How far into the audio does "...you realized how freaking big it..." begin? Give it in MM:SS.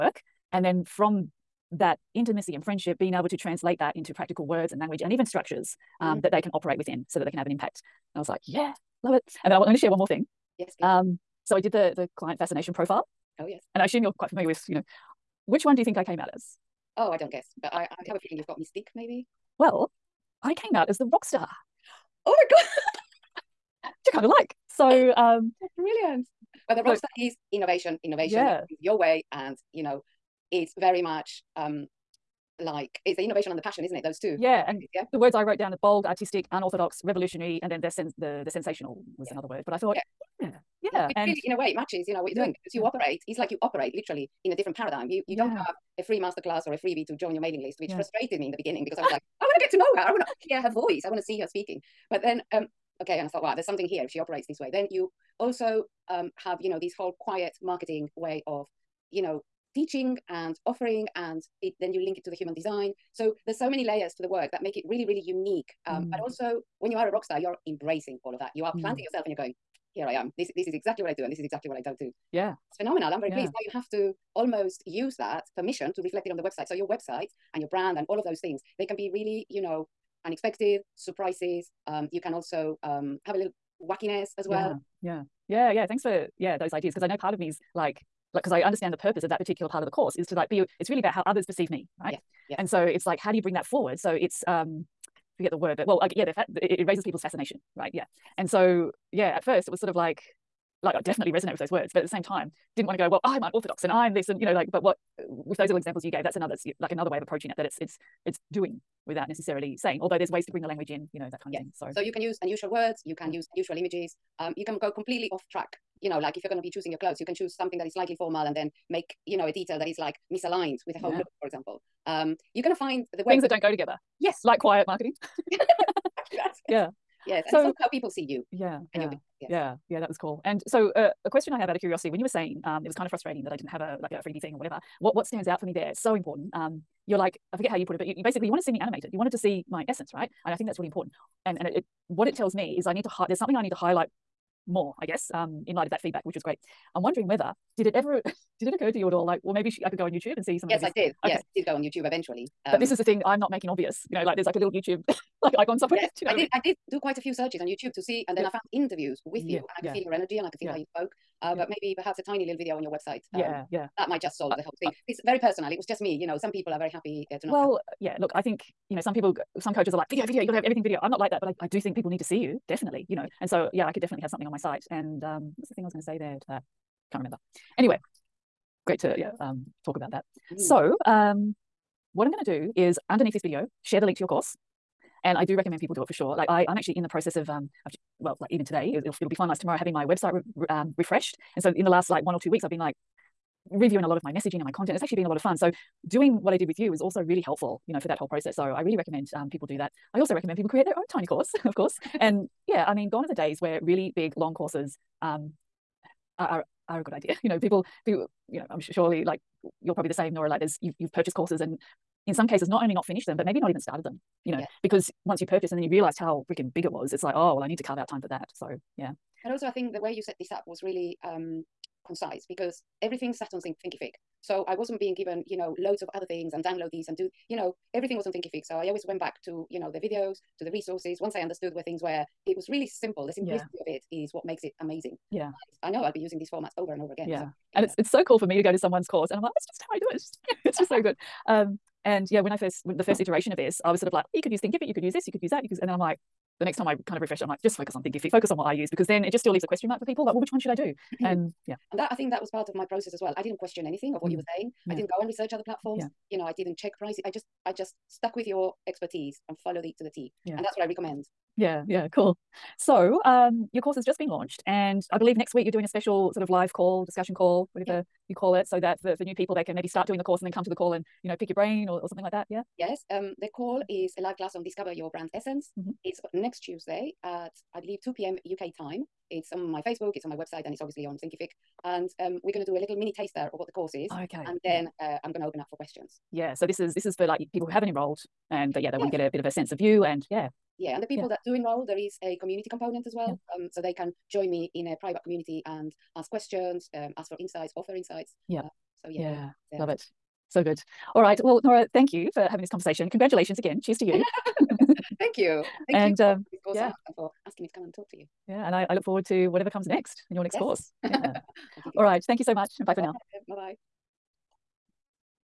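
03:35.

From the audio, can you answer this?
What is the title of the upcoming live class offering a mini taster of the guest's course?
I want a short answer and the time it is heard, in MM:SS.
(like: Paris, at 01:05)
Discover Your Brand Essence, at 04:34.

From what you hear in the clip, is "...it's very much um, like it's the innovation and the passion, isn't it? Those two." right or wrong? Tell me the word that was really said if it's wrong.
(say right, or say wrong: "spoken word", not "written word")
right.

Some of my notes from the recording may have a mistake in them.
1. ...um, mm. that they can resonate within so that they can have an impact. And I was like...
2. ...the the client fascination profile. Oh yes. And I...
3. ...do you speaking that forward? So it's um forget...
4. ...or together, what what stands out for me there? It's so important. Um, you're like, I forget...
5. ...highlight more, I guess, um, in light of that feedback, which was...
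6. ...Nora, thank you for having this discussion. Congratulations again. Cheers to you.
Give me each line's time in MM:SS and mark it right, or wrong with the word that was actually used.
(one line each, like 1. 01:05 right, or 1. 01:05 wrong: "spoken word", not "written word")
1. 00:06 wrong: "operate", not "resonate"
2. 00:11 right
3. 01:33 wrong: "bring", not "speaking"
4. 02:14 wrong: "whatever", not "together"
5. 02:23 right
6. 05:01 wrong: "conversation", not "discussion".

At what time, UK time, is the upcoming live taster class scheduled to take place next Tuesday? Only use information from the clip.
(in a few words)
2 p.m.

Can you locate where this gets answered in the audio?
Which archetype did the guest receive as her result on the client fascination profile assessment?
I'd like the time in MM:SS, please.
00:20.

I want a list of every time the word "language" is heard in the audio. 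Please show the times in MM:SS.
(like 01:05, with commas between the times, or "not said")
00:04, 01:50.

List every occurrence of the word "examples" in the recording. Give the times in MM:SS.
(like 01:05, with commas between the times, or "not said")
01:45, 02:01.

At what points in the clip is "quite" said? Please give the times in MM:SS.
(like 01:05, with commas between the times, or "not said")
00:14, 02:36.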